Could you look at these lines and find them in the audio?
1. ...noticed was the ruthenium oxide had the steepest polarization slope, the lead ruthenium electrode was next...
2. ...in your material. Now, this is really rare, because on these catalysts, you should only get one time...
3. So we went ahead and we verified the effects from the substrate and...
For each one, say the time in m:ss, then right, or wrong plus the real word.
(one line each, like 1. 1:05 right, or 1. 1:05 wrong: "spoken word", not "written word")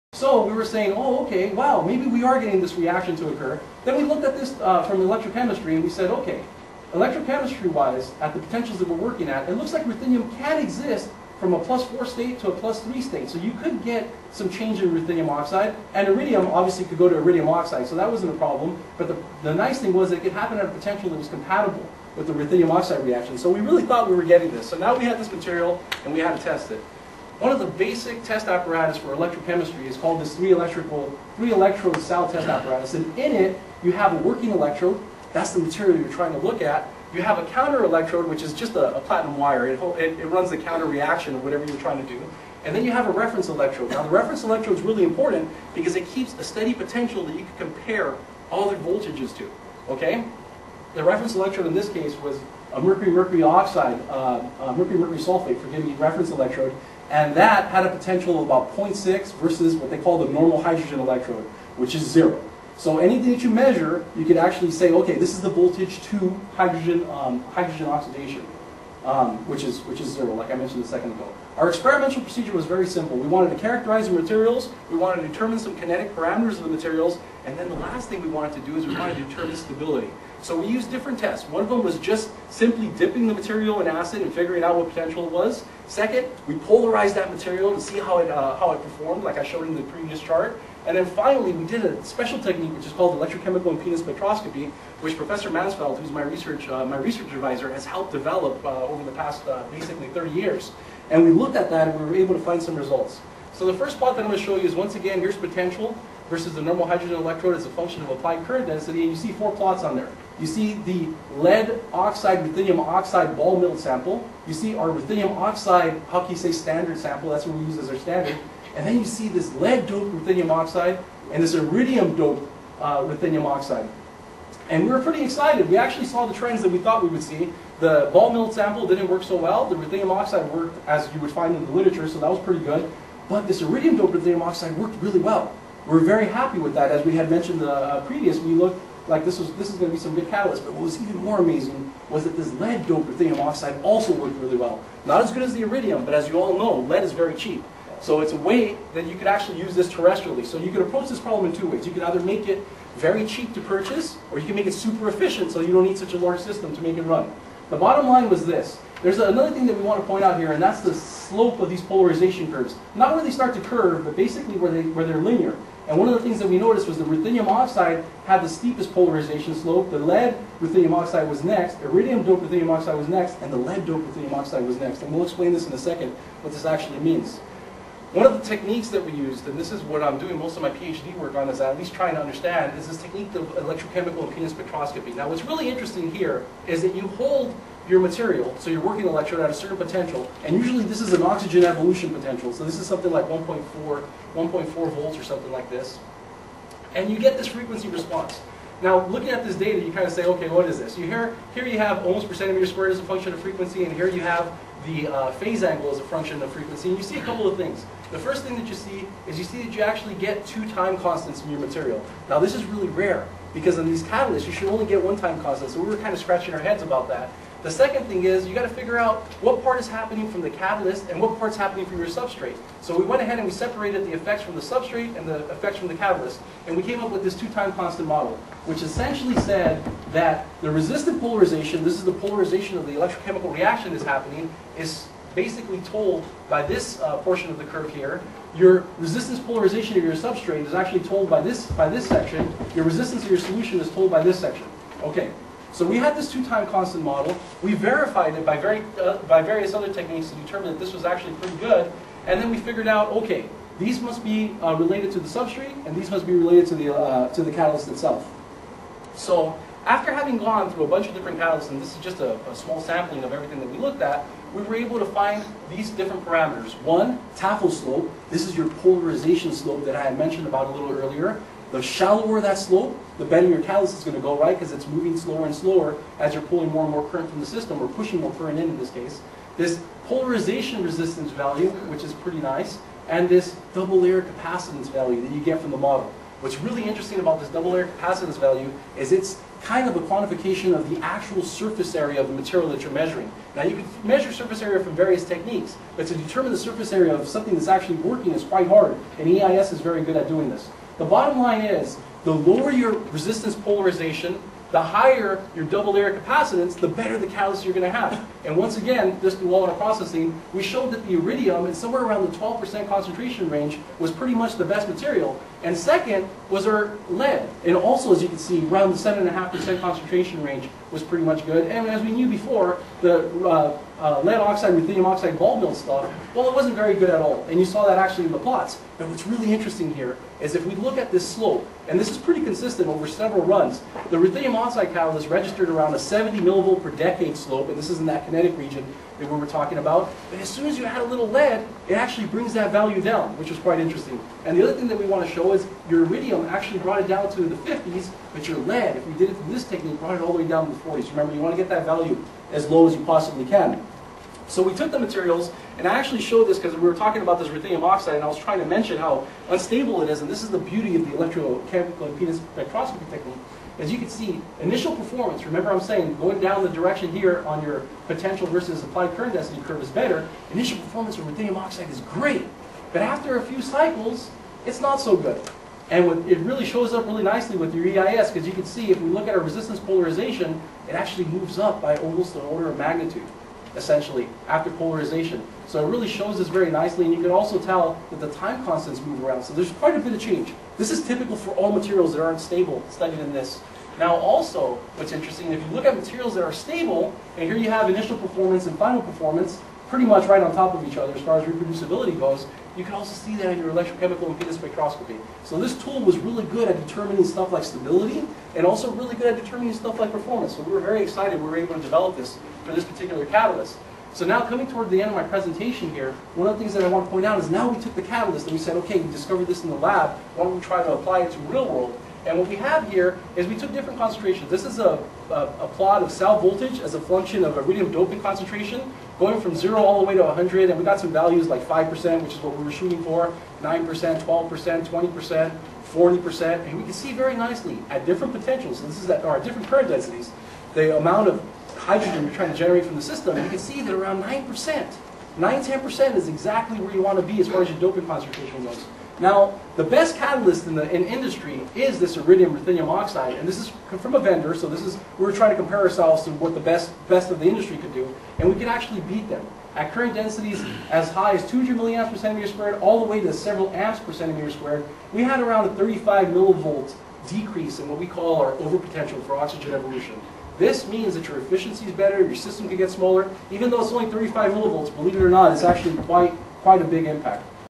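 1. 2:46 wrong: "oxide", not "electrode"
2. 3:31 right
3. 3:42 wrong: "separated", not "verified".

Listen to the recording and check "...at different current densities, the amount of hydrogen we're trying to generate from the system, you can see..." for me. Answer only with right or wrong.
right.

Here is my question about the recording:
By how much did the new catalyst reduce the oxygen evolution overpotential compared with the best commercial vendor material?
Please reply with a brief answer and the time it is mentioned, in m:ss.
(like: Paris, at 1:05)
35 millivolts, at 7:45.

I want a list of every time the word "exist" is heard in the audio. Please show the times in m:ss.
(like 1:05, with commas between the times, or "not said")
0:10.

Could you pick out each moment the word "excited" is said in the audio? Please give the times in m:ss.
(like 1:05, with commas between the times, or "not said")
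2:05, 6:51.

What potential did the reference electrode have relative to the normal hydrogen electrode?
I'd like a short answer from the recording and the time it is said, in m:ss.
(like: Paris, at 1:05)
About 0.6, at 0:58.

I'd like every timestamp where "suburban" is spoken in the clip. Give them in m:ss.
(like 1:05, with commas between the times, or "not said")
not said.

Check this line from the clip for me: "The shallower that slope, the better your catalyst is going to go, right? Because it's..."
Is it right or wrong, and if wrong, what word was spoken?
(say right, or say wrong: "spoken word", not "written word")
right.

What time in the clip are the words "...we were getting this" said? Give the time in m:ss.
0:24.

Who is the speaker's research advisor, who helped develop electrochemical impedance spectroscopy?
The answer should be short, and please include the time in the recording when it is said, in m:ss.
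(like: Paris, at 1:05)
Professor Mansfeld, at 1:35.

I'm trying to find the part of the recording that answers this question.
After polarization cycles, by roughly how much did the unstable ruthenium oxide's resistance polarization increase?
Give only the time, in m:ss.
6:22.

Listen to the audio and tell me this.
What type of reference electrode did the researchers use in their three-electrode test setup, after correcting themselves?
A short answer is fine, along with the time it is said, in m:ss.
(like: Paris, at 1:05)
Mercury-mercury sulfate, at 0:54.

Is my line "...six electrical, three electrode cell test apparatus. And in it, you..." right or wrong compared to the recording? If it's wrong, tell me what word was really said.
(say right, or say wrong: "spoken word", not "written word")
wrong: "three", not "six".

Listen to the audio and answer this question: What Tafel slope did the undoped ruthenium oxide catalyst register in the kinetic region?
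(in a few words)
70 millivolts per decade.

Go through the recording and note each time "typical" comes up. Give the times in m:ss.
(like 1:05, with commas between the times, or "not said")
6:31.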